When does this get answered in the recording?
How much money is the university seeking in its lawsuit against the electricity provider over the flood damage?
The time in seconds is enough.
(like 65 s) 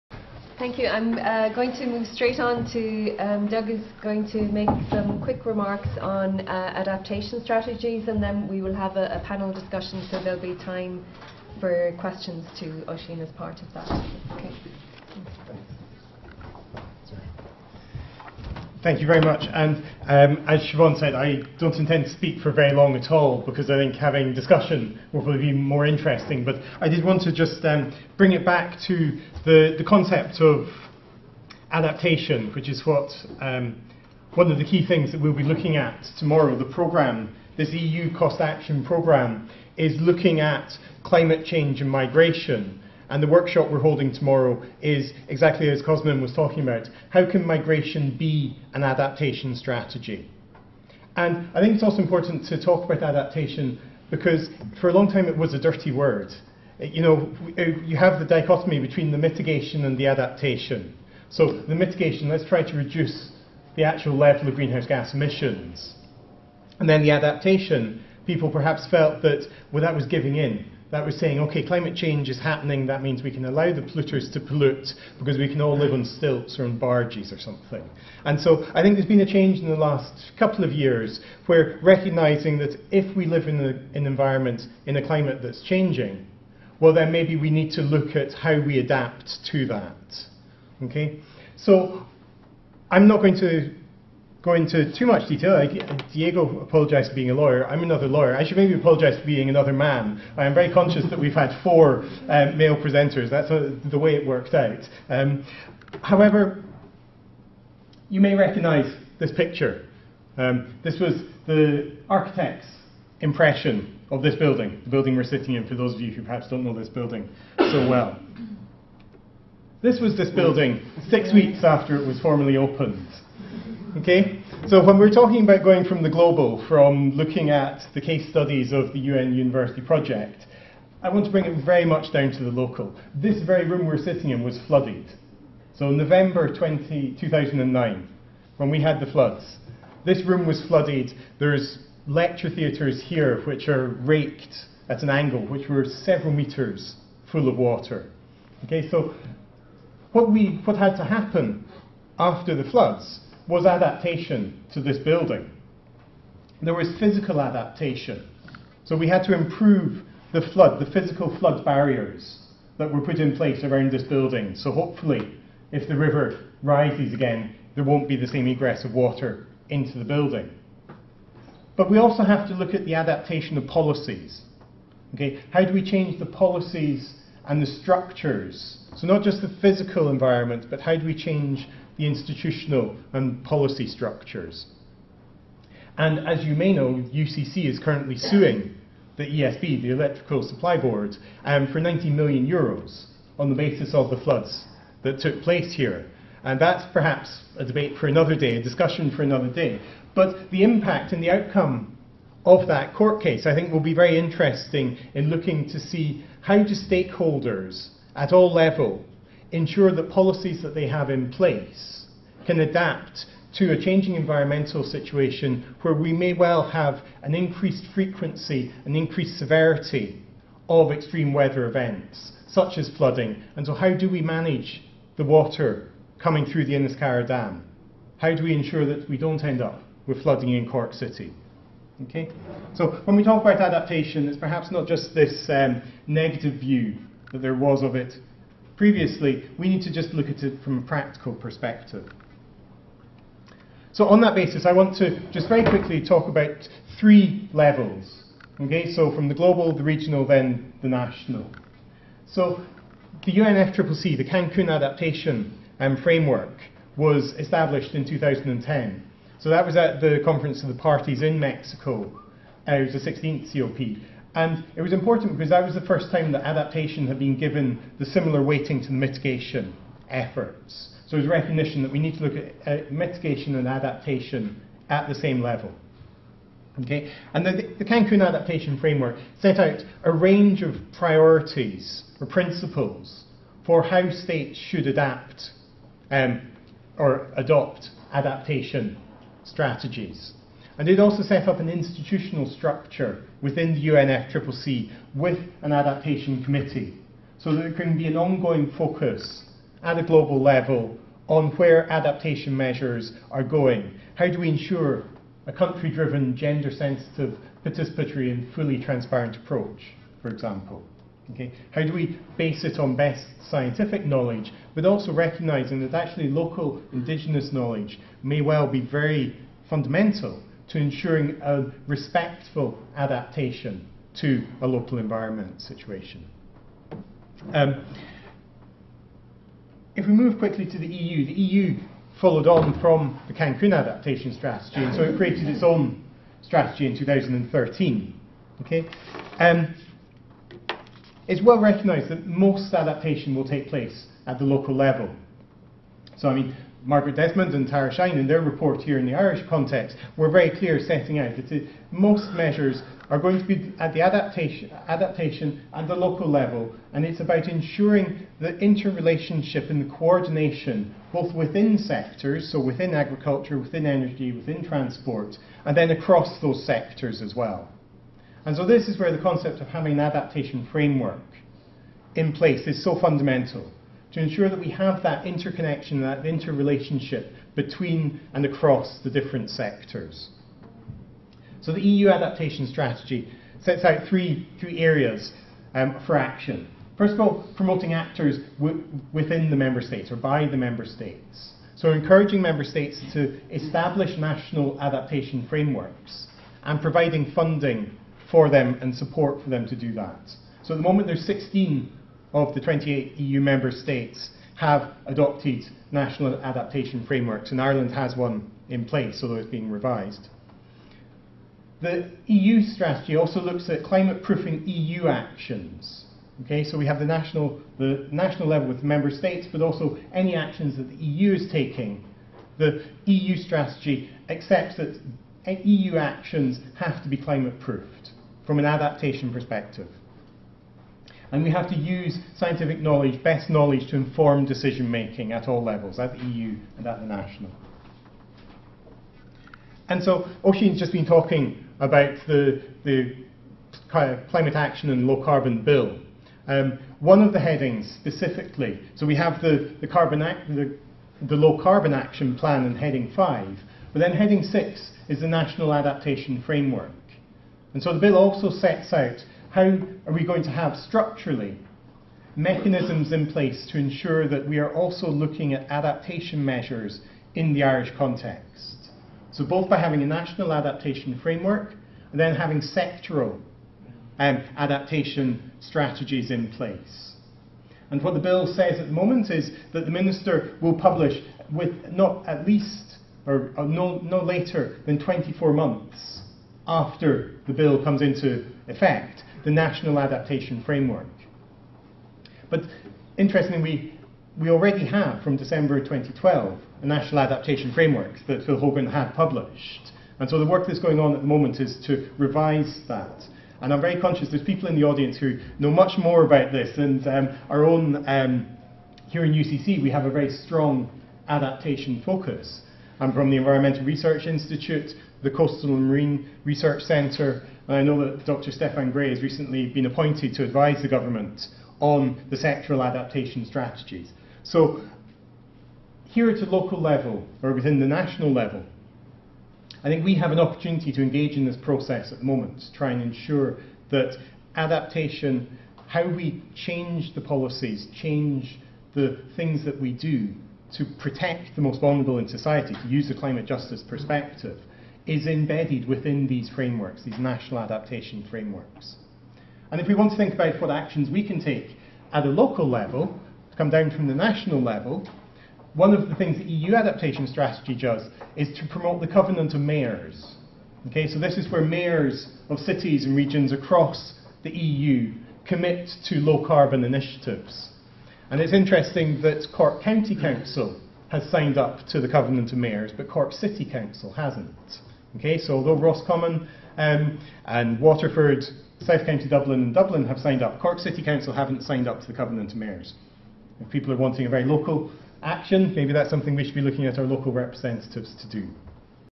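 191 s.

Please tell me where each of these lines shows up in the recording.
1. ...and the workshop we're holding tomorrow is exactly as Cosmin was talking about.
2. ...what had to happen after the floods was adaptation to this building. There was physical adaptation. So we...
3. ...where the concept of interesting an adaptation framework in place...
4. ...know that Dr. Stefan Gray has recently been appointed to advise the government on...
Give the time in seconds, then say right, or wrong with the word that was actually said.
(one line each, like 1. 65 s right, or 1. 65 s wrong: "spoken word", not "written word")
1. 43 s right
2. 150 s right
3. 368 s wrong: "having", not "interesting"
4. 517 s right.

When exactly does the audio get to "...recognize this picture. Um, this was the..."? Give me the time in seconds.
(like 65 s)
108 s.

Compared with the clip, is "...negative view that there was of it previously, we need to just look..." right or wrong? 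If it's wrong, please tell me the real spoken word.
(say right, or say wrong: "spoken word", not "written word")
right.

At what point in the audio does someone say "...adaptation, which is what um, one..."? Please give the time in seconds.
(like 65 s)
31 s.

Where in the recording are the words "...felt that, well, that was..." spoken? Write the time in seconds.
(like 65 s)
68 s.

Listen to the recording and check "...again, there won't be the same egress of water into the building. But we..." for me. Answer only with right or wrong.
right.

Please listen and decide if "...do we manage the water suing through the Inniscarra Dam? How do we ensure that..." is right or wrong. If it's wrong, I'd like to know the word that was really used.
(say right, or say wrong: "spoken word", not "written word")
wrong: "coming", not "suing".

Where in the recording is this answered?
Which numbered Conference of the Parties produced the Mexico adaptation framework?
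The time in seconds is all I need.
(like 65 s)
263 s.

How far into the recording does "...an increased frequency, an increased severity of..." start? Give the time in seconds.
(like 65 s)
217 s.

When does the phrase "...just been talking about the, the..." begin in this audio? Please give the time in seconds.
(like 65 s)
440 s.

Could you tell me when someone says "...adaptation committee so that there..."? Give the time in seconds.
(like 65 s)
295 s.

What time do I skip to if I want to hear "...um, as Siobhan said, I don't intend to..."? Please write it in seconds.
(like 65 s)
20 s.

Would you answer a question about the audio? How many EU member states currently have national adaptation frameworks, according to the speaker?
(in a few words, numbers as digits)
16.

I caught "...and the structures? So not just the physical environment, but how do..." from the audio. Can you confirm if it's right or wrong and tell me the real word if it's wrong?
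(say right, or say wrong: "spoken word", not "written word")
right.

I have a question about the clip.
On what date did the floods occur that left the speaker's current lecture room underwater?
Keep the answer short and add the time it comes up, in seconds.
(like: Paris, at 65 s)
November 20, 2009, at 135 s.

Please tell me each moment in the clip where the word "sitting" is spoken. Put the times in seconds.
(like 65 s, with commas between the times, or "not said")
115 s, 133 s.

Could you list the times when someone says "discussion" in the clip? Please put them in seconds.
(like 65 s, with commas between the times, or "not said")
9 s, 24 s, 198 s.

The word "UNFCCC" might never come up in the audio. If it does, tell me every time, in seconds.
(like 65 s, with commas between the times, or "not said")
253 s, 293 s.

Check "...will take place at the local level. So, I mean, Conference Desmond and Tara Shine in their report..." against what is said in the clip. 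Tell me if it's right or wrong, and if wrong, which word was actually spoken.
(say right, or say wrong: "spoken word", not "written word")
wrong: "Margaret", not "Conference".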